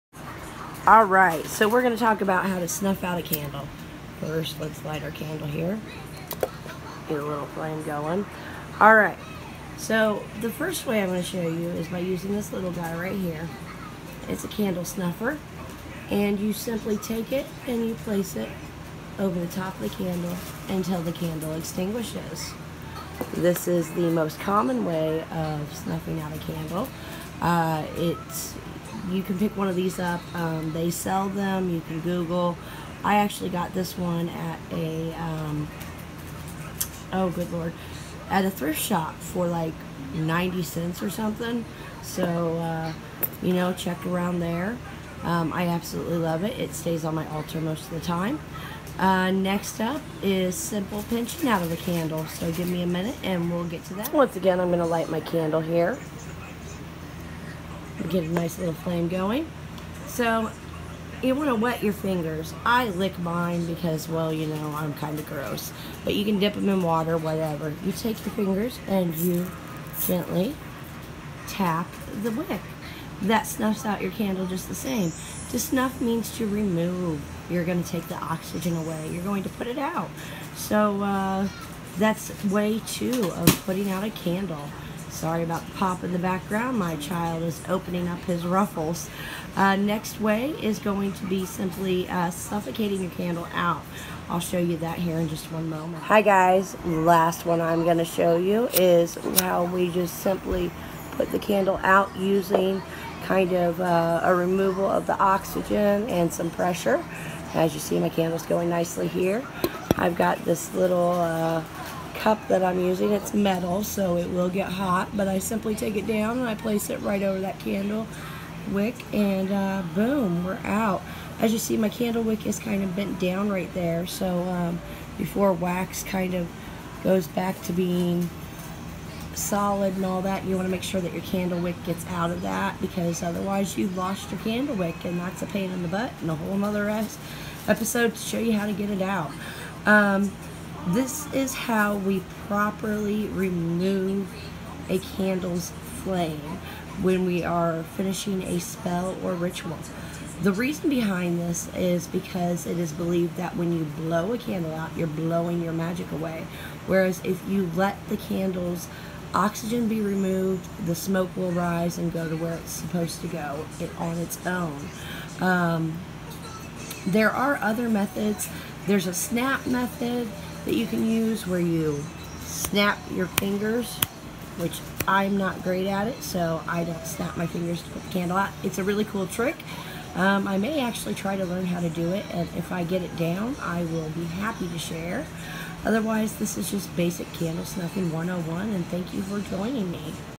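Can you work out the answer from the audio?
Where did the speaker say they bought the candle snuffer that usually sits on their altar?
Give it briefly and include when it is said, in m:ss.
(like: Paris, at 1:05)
thrift shop, at 0:38.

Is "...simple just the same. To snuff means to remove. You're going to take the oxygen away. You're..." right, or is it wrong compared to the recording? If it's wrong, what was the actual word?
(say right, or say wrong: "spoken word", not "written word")
wrong: "candle", not "simple".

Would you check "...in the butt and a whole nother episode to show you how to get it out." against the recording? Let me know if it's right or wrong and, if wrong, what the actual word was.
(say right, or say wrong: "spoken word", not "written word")
right.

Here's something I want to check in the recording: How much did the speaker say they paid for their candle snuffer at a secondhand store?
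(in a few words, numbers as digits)
90 cents.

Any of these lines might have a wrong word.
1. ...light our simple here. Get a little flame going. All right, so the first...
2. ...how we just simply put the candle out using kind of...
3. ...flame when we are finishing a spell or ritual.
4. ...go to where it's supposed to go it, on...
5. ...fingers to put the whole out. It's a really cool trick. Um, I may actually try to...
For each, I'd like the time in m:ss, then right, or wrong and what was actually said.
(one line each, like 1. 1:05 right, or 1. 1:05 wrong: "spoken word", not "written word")
1. 0:04 wrong: "candle", not "simple"
2. 1:39 right
3. 2:26 right
4. 2:42 right
5. 2:57 wrong: "candle", not "whole".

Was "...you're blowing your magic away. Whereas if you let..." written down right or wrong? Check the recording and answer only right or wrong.
right.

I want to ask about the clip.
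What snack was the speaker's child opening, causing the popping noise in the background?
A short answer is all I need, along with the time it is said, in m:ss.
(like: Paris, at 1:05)
Ruffles, at 1:28.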